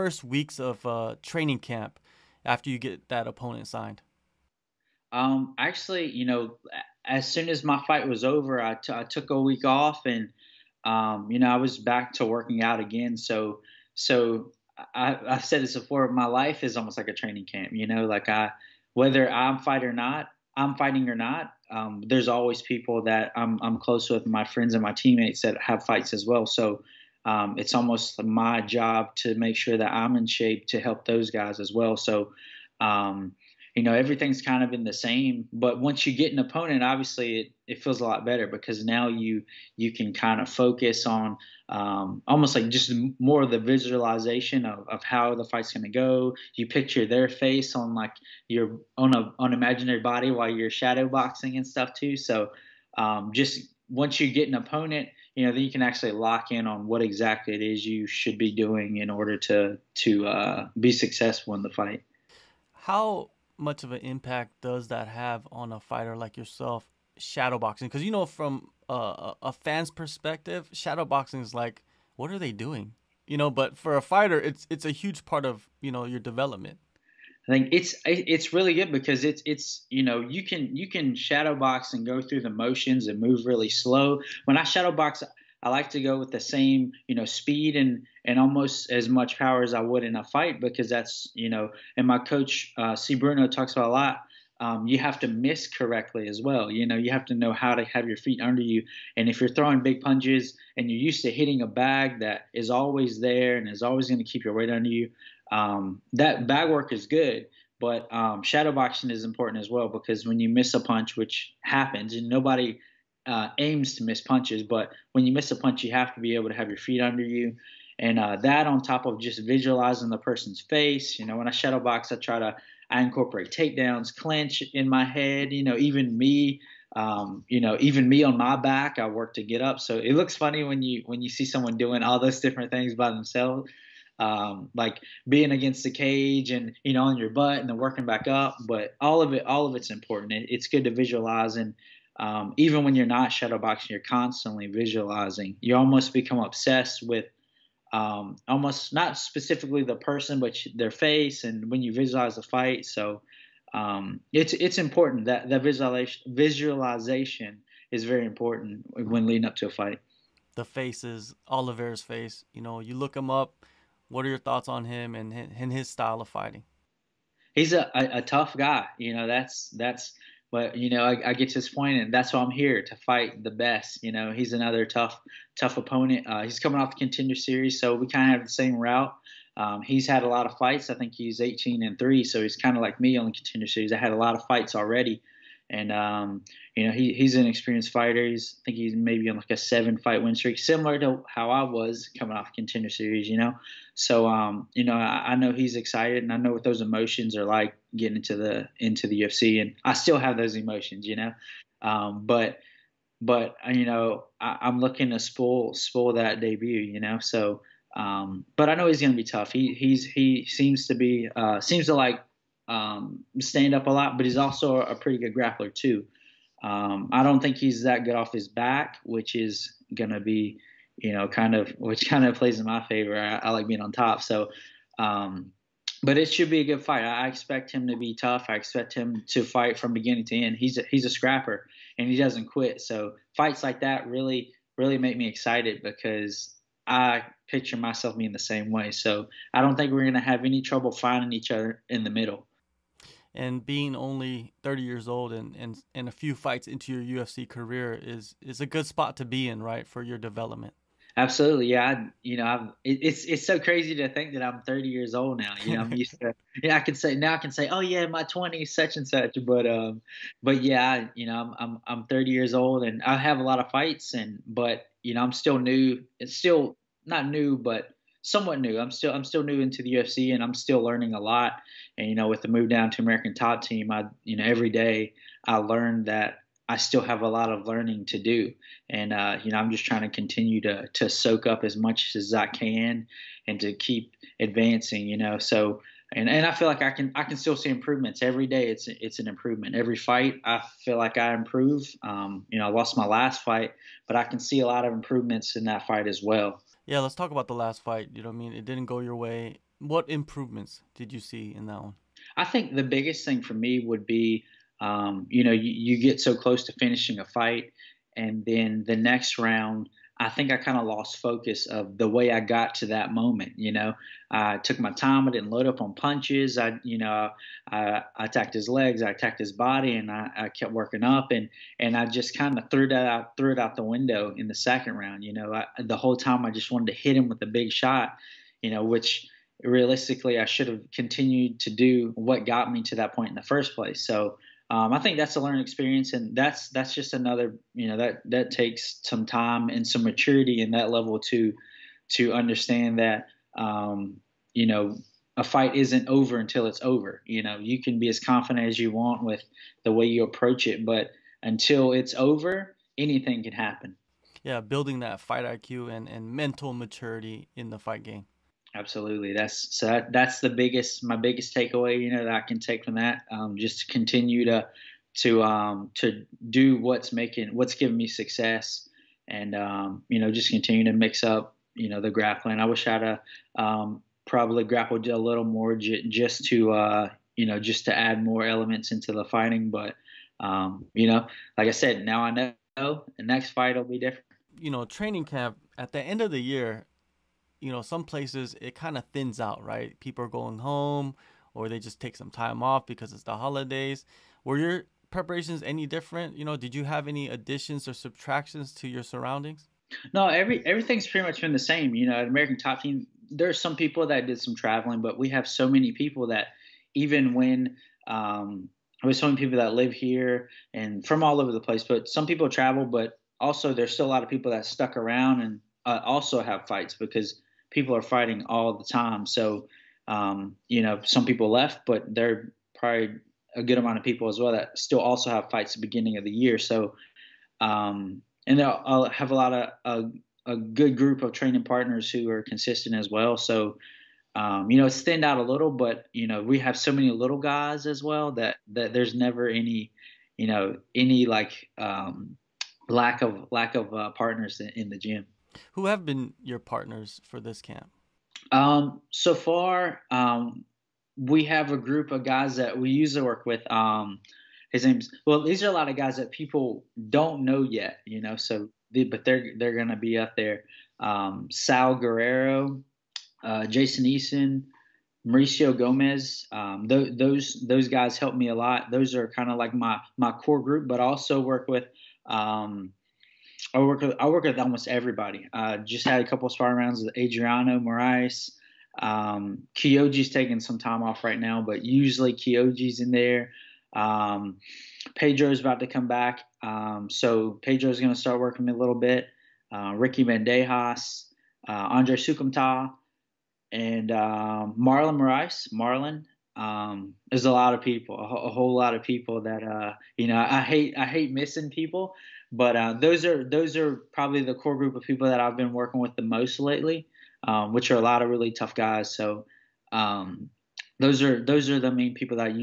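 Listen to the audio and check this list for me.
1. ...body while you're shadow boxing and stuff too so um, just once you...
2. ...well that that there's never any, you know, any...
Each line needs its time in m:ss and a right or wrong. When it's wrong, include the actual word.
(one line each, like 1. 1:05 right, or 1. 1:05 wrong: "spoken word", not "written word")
1. 0:50 right
2. 7:18 right.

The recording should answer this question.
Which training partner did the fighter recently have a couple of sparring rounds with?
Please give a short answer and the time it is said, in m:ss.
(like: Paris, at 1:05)
Adriano Moraes, at 7:57.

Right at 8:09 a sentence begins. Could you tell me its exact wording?
Uh, Ricky Bandejas, uh, Andre Soukhamthath, and um, Marlon Moraes.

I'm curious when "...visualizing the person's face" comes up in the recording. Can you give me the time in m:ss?
1:59.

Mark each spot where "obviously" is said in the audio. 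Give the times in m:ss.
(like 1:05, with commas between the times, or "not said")
0:36.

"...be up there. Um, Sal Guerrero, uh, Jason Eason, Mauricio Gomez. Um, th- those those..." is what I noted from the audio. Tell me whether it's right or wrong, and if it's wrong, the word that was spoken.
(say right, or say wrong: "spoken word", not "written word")
right.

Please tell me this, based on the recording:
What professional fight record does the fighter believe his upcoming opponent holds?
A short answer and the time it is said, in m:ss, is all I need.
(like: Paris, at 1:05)
18 and 3, at 3:01.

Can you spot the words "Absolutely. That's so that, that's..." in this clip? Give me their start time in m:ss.
5:58.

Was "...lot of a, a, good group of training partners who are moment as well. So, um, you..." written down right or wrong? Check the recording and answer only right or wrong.
wrong.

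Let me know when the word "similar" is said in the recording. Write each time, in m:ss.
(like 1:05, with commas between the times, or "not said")
3:10.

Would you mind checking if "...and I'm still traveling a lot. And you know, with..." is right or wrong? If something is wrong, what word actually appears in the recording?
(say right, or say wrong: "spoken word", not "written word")
wrong: "learning", not "traveling".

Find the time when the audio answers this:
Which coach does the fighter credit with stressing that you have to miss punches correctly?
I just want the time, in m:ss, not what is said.
1:32.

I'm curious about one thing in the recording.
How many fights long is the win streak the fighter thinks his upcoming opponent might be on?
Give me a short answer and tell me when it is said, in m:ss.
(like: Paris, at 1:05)
seven fight, at 3:09.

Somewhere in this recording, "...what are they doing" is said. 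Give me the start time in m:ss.
1:12.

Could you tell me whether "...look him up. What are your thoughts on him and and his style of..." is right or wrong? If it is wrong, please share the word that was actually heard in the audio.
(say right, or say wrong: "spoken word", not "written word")
right.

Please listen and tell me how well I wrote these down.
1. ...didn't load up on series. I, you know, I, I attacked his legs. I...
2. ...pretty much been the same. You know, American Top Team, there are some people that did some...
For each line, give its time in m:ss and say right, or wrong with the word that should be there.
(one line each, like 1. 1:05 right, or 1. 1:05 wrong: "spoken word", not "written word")
1. 5:15 wrong: "punches", not "series"
2. 6:41 right.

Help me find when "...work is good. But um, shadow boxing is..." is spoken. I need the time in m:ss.
1:46.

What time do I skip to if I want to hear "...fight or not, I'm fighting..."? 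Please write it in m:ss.
0:19.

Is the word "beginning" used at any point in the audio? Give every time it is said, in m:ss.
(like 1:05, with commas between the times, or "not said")
3:49, 7:05.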